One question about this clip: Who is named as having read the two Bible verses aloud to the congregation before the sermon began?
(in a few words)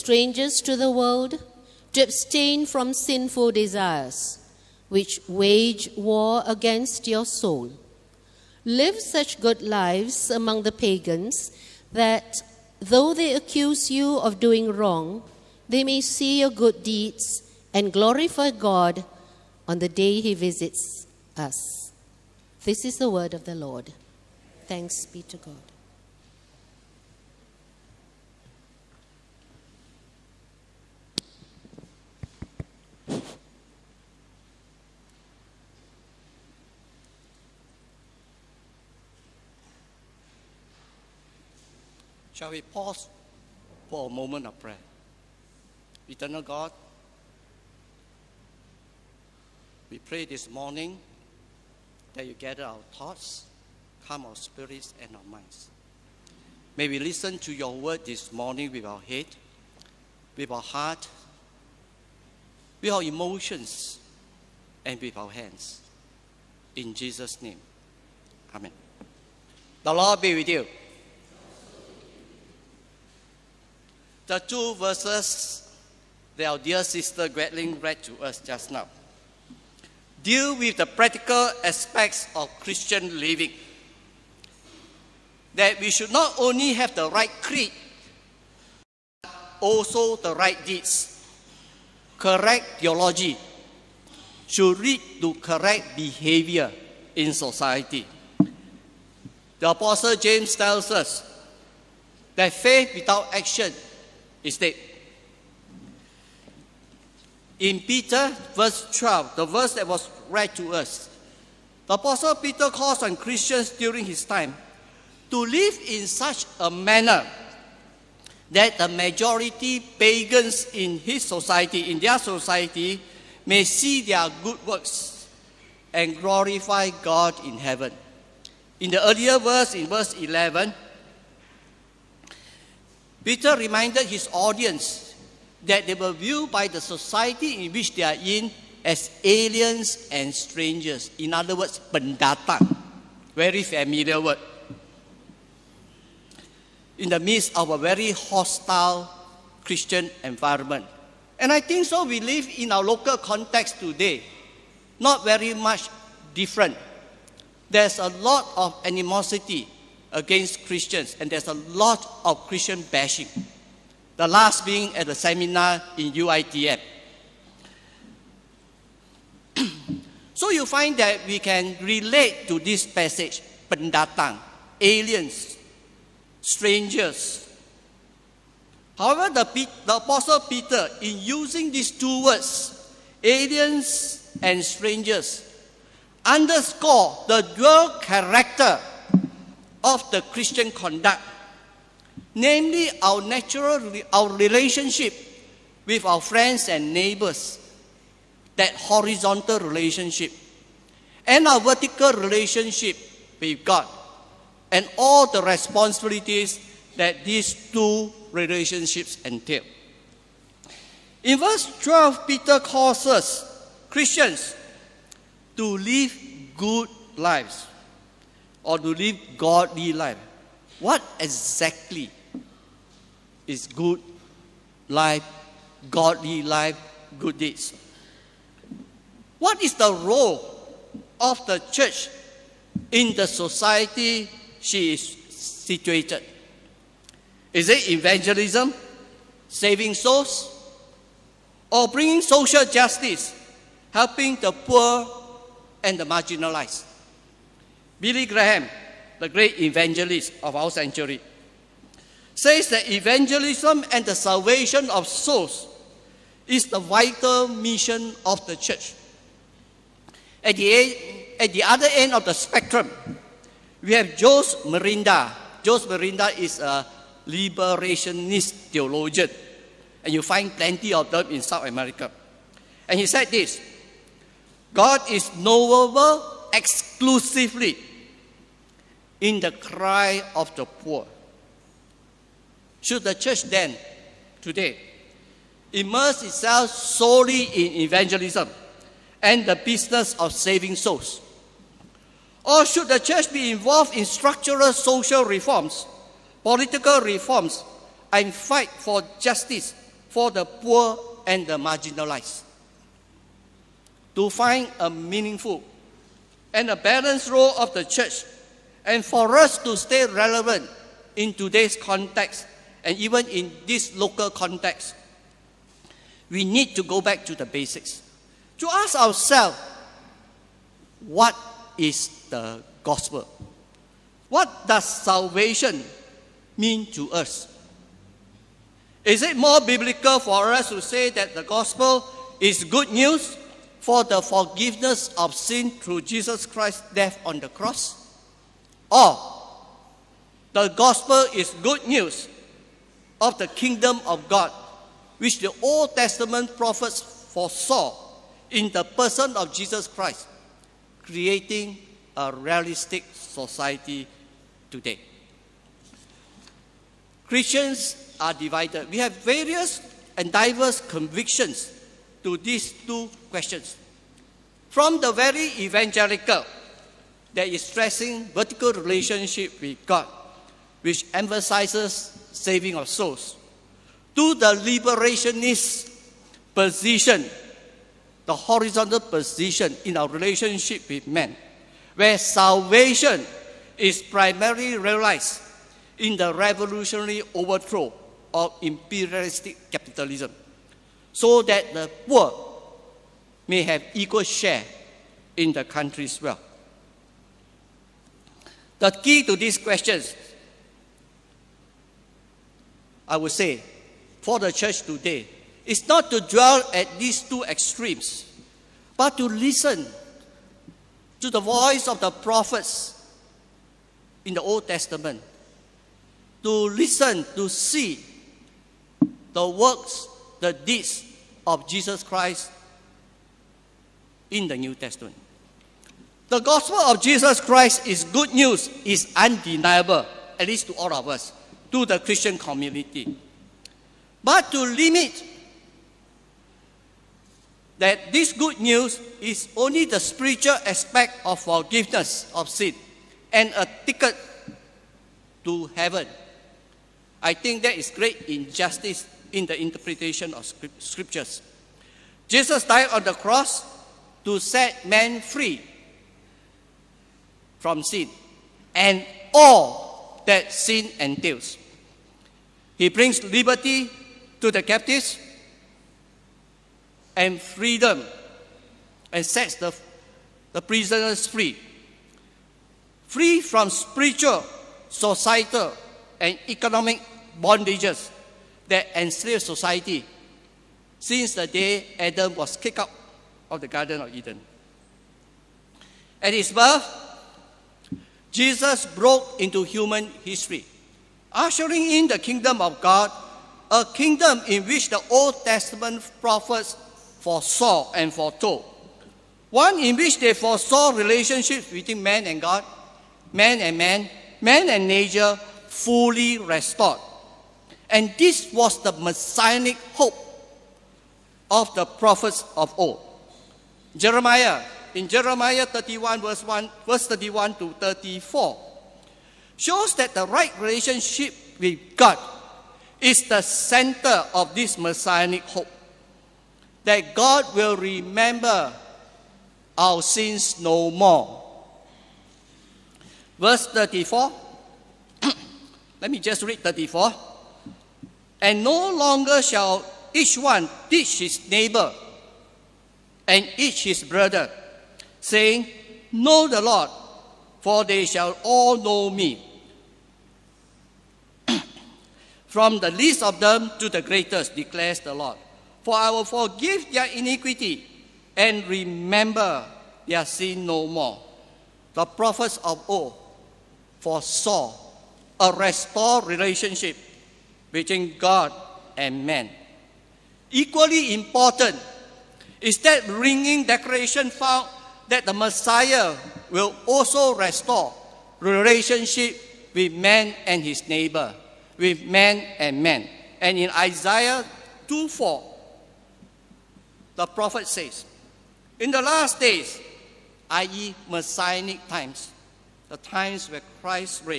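Gretling.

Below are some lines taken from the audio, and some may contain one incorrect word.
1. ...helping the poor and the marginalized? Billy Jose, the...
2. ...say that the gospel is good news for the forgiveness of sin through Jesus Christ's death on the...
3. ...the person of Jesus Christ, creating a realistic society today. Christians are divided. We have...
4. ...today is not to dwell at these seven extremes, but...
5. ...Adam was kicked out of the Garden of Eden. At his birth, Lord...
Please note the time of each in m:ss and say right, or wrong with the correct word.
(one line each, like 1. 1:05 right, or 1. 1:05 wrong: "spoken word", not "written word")
1. 4:03 wrong: "Graham", not "Jose"
2. 5:30 right
3. 5:48 right
4. 6:44 wrong: "two", not "seven"
5. 8:01 wrong: "Jesus", not "Lord".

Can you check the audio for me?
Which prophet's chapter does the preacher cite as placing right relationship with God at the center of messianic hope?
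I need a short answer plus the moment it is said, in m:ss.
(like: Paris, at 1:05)
Jeremiah 31, at 8:35.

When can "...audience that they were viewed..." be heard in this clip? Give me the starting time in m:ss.
2:14.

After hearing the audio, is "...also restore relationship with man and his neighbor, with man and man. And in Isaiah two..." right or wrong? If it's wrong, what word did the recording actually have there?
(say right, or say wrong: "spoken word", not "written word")
right.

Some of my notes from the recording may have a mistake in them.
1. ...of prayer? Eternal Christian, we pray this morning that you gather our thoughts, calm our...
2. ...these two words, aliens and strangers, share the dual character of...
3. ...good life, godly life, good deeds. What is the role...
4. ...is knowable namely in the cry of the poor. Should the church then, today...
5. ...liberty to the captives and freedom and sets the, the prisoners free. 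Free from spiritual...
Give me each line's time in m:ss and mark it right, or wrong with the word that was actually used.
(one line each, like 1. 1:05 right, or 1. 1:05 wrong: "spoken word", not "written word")
1. 0:44 wrong: "God", not "Christian"
2. 3:01 wrong: "underscore", not "share"
3. 3:43 right
4. 4:35 wrong: "exclusively", not "namely"
5. 7:43 right.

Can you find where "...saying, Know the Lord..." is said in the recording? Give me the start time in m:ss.
9:05.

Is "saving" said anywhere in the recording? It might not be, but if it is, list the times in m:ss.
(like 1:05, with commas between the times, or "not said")
3:59, 4:50, 6:12.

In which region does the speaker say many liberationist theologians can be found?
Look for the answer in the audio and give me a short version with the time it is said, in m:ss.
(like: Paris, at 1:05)
South America, at 4:31.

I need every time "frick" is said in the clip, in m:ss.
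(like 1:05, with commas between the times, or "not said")
not said.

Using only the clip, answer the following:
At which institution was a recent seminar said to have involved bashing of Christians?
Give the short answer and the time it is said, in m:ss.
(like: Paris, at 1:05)
UITF, at 2:46.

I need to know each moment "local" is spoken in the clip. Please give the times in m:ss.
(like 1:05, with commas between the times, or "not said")
2:32, 5:13.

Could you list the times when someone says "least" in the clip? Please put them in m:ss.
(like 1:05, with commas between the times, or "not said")
7:10, 9:12.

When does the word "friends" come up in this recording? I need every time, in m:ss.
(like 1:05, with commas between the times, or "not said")
3:16.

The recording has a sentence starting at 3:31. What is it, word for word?
In verse 12, Peter calls us Christians to live good lives or to live godly life.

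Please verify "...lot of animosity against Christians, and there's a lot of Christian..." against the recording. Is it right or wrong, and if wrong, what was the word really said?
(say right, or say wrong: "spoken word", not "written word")
right.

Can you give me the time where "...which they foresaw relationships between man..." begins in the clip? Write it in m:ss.
8:19.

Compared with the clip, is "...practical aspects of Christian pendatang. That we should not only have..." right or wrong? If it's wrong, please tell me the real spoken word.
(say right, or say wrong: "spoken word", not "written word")
wrong: "living", not "pendatang".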